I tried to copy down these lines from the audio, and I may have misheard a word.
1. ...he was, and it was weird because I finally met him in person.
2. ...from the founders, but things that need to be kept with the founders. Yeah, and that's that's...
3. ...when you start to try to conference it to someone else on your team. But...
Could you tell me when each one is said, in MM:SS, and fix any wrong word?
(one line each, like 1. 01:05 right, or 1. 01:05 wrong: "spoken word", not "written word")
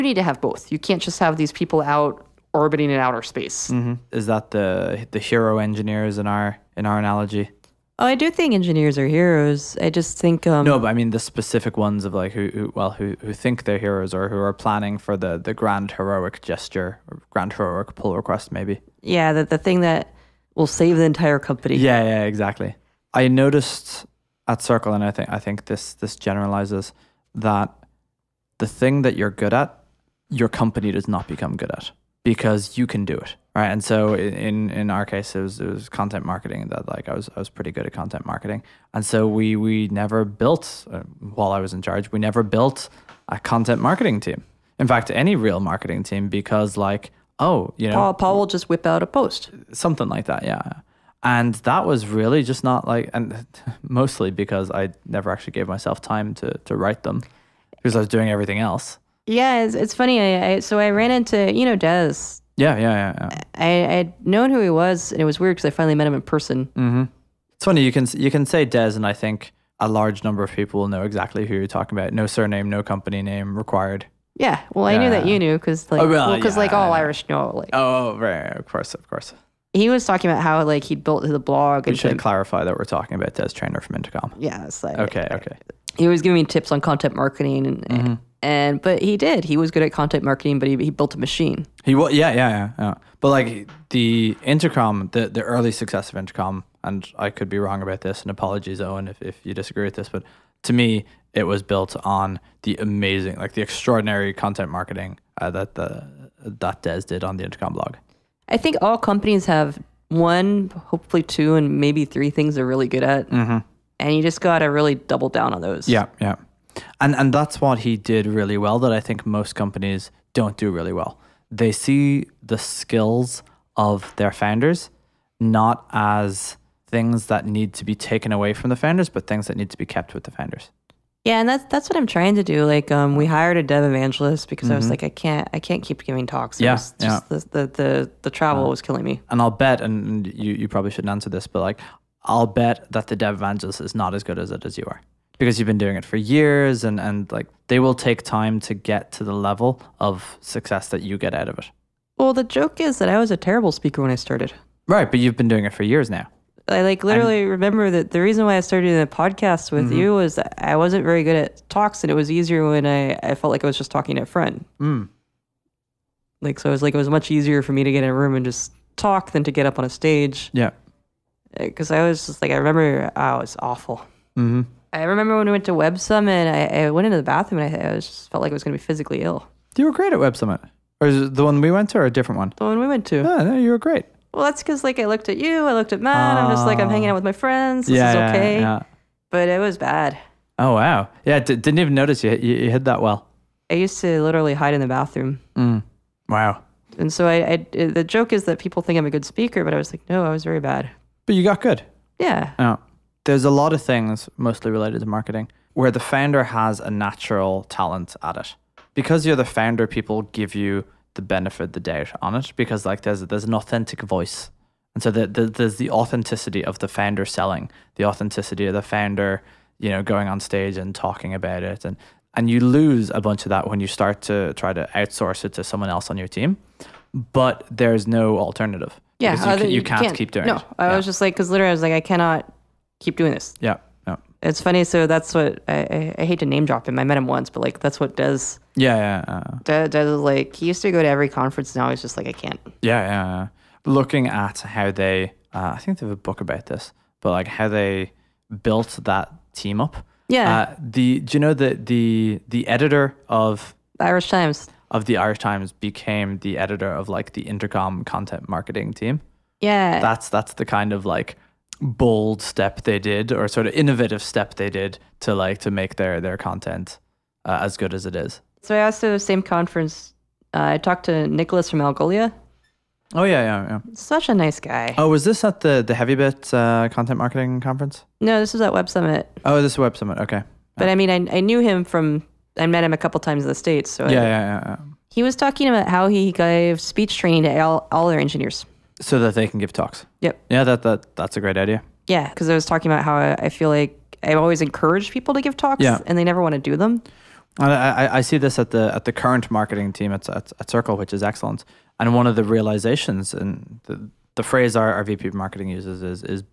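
1. 01:04 right
2. 02:08 right
3. 03:43 wrong: "outsource", not "conference".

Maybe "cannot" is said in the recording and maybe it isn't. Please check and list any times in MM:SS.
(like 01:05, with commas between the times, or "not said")
03:51.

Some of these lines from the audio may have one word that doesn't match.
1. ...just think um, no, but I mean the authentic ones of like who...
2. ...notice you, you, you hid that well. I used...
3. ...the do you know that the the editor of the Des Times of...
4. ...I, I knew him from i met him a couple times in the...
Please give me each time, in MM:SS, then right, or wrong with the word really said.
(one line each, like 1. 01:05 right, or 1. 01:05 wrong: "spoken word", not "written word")
1. 00:09 wrong: "specific", not "authentic"
2. 03:11 right
3. 04:10 wrong: "Irish", not "Des"
4. 04:41 right.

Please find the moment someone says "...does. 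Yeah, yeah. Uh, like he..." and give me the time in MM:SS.
03:58.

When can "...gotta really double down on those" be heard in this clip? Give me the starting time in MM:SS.
01:54.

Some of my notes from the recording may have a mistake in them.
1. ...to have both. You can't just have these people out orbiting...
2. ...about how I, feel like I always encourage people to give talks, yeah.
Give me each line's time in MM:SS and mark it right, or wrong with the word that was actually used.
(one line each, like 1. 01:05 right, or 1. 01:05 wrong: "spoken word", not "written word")
1. 00:00 right
2. 04:52 right.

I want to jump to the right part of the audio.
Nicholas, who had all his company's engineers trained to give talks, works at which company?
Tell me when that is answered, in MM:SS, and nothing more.
04:31.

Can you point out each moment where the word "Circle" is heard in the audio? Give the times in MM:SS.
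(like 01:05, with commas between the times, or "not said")
00:24, 05:00.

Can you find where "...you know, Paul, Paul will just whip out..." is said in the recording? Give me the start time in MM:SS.
00:47.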